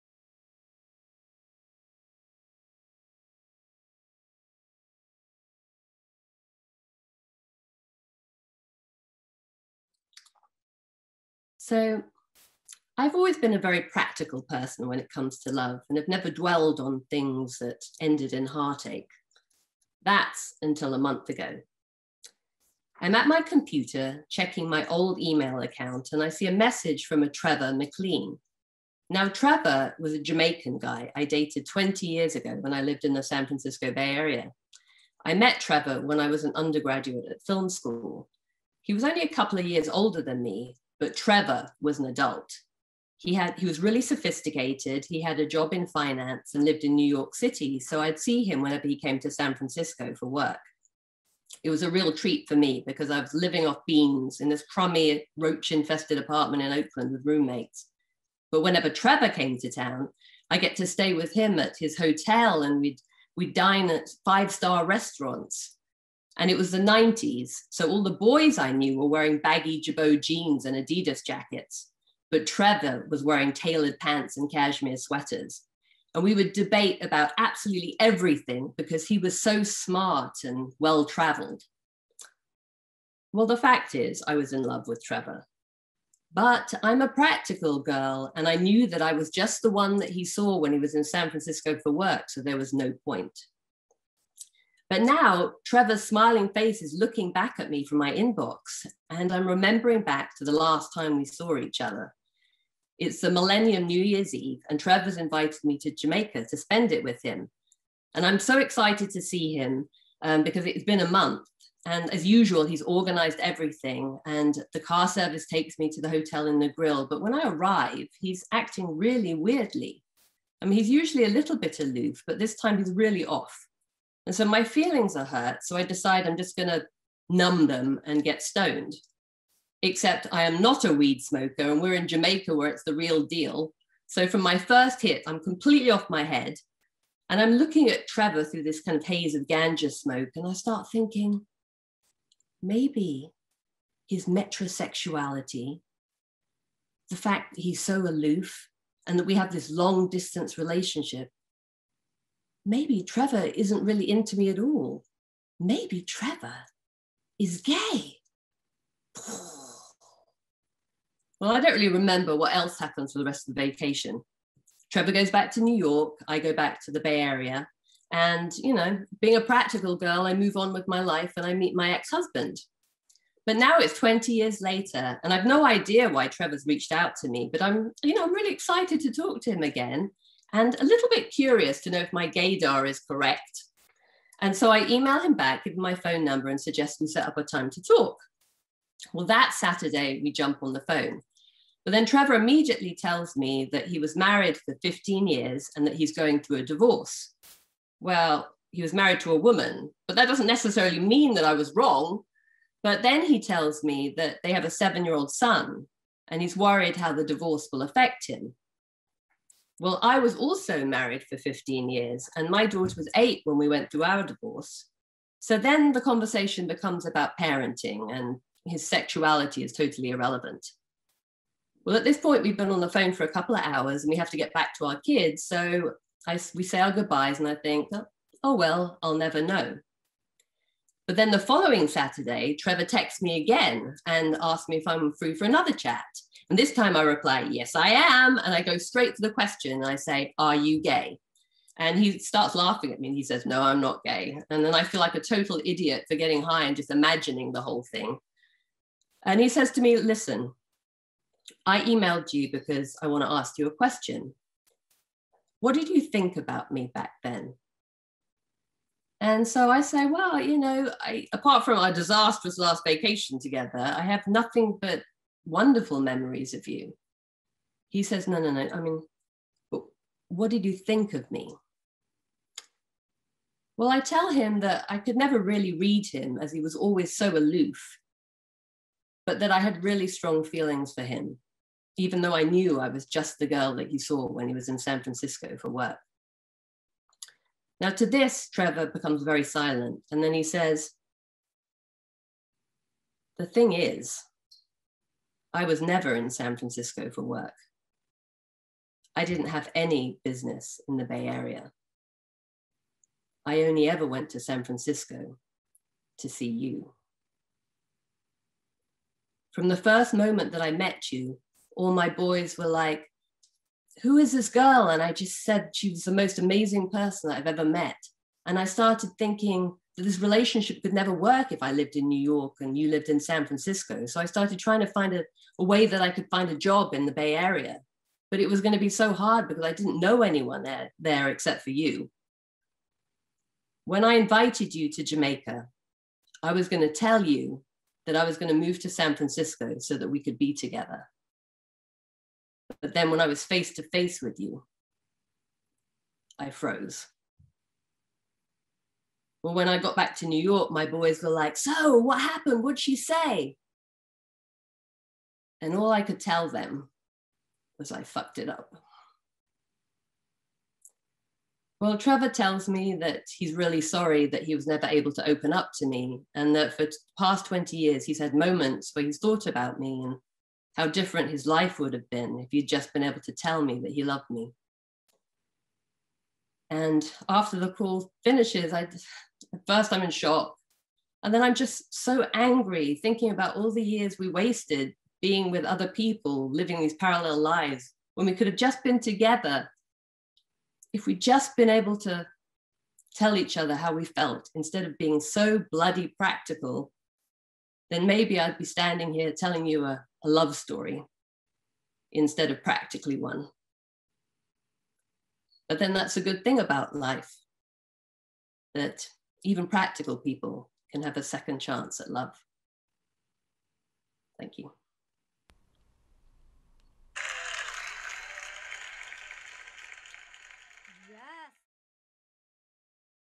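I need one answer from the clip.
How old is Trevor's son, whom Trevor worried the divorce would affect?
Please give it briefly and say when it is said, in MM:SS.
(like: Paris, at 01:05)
7, at 03:24.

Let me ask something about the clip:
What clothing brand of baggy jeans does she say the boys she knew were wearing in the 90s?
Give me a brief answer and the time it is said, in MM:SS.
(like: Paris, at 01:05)
Girbaud, at 01:09.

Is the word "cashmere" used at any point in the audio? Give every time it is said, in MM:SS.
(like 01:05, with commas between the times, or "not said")
01:14.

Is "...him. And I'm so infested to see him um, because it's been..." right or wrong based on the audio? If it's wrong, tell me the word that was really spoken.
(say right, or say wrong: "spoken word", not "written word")
wrong: "excited", not "infested".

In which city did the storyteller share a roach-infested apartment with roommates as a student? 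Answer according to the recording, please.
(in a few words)
Oakland.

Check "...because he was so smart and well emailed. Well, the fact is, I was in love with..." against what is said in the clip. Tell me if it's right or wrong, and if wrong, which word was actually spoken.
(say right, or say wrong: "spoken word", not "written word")
wrong: "traveled", not "emailed".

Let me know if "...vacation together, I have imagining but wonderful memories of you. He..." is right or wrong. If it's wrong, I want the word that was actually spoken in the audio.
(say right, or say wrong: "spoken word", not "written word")
wrong: "nothing", not "imagining".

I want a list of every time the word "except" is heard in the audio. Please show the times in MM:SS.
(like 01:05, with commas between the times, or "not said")
02:09, 05:31.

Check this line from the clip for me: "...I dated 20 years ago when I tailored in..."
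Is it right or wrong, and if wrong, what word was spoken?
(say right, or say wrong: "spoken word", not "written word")
wrong: "lived", not "tailored".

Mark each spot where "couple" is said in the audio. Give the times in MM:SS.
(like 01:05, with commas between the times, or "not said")
00:39, 03:43.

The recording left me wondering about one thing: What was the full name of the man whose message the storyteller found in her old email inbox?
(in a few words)
Trevor McLean.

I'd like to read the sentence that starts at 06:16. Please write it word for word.
And after the call finishes, I first I'm in shock.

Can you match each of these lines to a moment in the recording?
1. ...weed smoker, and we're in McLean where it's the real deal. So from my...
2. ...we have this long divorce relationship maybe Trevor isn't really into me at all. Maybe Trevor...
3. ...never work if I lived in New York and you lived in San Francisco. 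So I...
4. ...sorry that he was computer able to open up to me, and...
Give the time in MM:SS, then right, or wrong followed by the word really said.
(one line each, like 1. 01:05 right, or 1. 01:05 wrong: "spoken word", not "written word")
1. 02:10 wrong: "Jamaica", not "McLean"
2. 02:29 wrong: "distance", not "divorce"
3. 05:20 right
4. 06:03 wrong: "never", not "computer".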